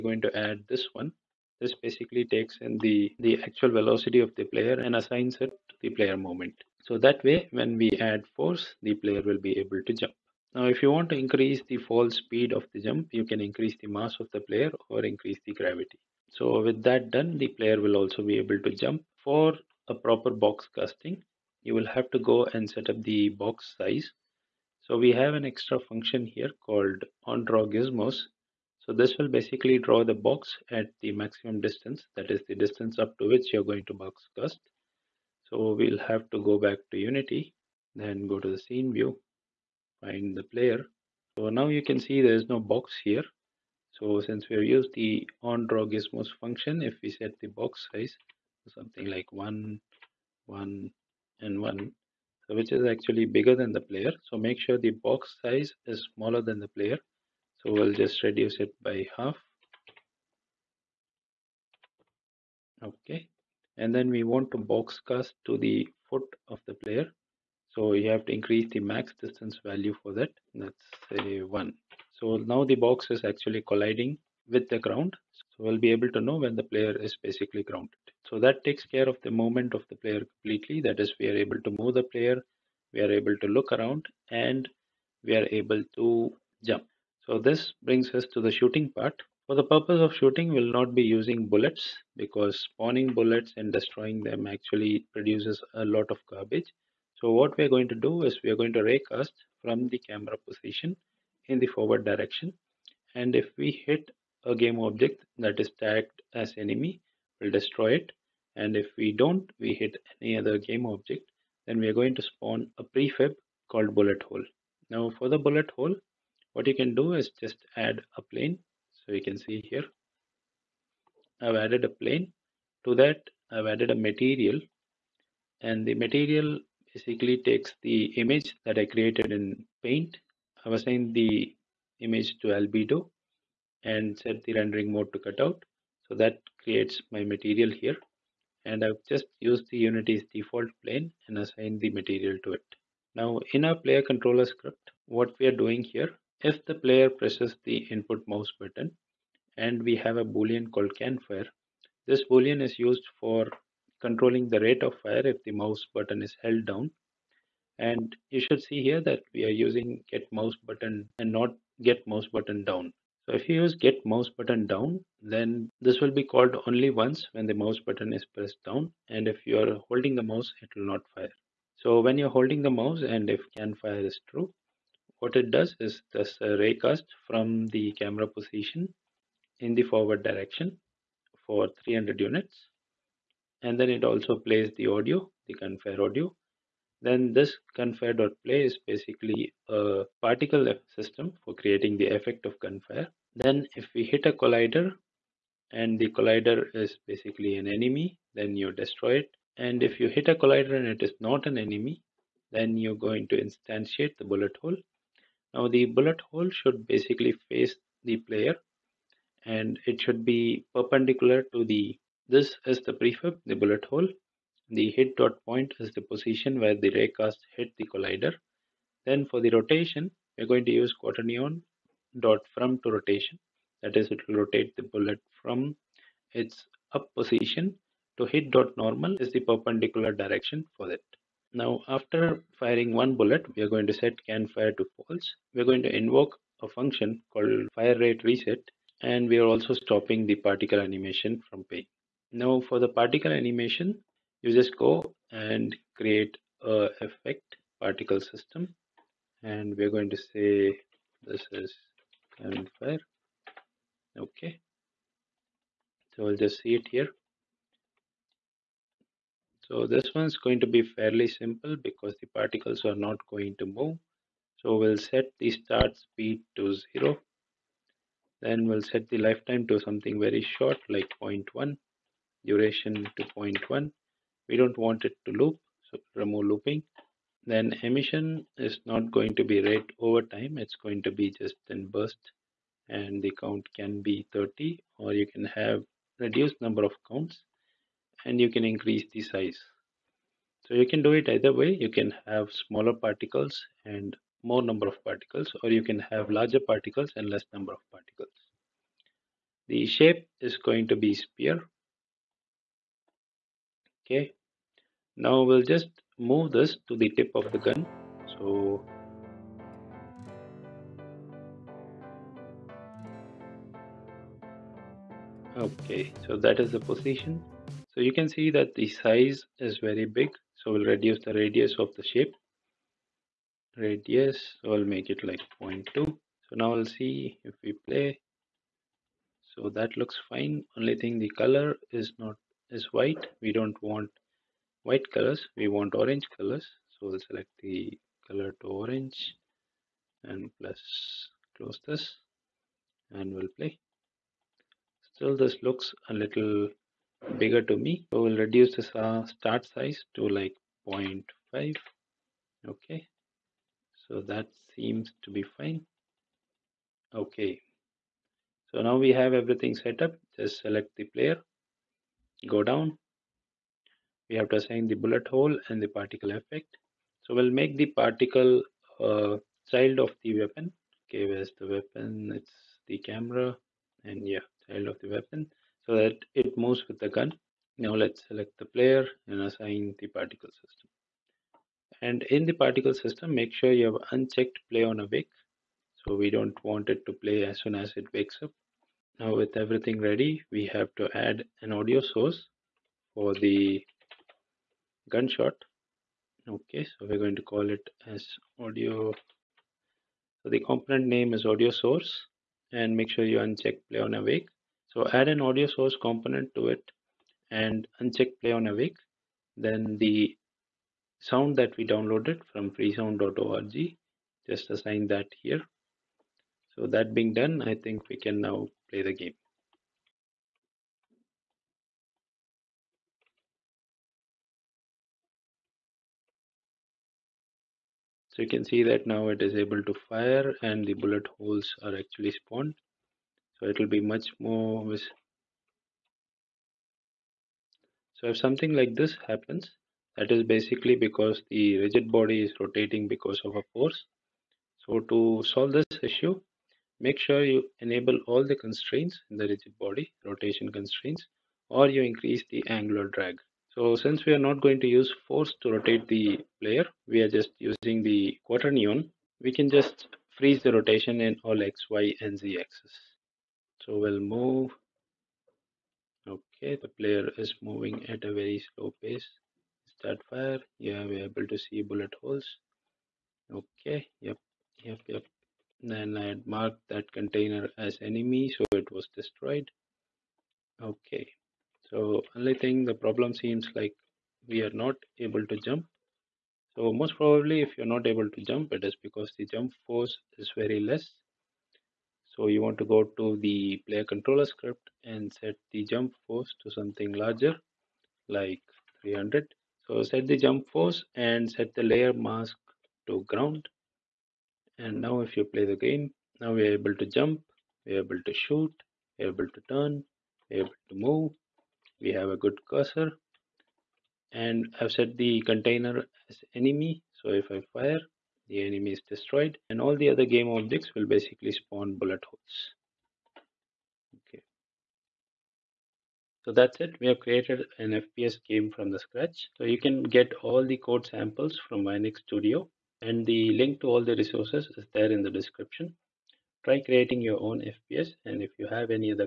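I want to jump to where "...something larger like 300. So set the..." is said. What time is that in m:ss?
8:16.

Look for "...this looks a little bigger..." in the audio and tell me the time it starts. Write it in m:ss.
5:45.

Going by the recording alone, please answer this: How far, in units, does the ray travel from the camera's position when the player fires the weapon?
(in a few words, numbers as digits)
300 units.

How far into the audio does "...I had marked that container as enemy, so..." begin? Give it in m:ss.
7:56.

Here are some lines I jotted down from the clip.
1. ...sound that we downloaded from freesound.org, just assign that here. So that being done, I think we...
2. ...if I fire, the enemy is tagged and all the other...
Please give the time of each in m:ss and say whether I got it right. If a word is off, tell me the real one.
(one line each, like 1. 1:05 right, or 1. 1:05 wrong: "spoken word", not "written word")
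1. 6:51 right
2. 8:37 wrong: "destroyed", not "tagged".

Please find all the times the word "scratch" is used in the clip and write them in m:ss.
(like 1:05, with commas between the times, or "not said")
8:48.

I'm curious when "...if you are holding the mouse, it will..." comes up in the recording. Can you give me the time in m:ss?
2:49.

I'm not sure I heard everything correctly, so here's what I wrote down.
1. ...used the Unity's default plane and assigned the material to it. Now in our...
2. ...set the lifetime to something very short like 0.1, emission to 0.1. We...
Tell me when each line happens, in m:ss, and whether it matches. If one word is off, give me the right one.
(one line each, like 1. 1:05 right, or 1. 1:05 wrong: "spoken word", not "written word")
1. 2:19 right
2. 4:28 wrong: "duration", not "emission".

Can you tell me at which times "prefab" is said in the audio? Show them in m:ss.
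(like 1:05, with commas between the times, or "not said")
1:52, 3:32.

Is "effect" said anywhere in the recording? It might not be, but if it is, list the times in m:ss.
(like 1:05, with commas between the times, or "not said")
3:12, 4:07, 6:06.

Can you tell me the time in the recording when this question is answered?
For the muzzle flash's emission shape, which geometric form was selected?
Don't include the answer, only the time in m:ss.
5:01.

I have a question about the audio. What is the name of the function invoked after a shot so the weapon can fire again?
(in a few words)
fire rate reset.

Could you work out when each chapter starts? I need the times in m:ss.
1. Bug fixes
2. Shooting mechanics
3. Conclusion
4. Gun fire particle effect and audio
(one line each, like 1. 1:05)
1. 7:00
2. 1:27
3. 8:26
4. 4:01.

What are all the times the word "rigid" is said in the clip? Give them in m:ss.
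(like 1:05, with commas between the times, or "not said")
7:21, 7:29.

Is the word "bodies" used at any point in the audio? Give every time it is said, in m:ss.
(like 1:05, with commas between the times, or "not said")
not said.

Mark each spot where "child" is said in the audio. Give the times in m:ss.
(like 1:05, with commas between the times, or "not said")
6:09, 6:14.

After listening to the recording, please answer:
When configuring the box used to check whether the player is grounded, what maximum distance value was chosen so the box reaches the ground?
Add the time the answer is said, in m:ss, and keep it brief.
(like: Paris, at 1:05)
1, at 1:10.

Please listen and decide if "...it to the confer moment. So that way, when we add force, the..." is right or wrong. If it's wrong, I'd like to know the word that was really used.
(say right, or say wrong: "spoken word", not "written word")
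wrong: "player", not "confer".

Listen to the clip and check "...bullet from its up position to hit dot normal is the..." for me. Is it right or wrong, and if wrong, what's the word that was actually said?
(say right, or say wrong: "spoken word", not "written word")
right.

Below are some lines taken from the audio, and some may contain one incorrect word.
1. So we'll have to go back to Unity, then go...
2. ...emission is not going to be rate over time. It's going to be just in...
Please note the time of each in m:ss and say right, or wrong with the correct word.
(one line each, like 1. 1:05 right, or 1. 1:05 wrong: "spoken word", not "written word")
1. 0:35 right
2. 4:37 right.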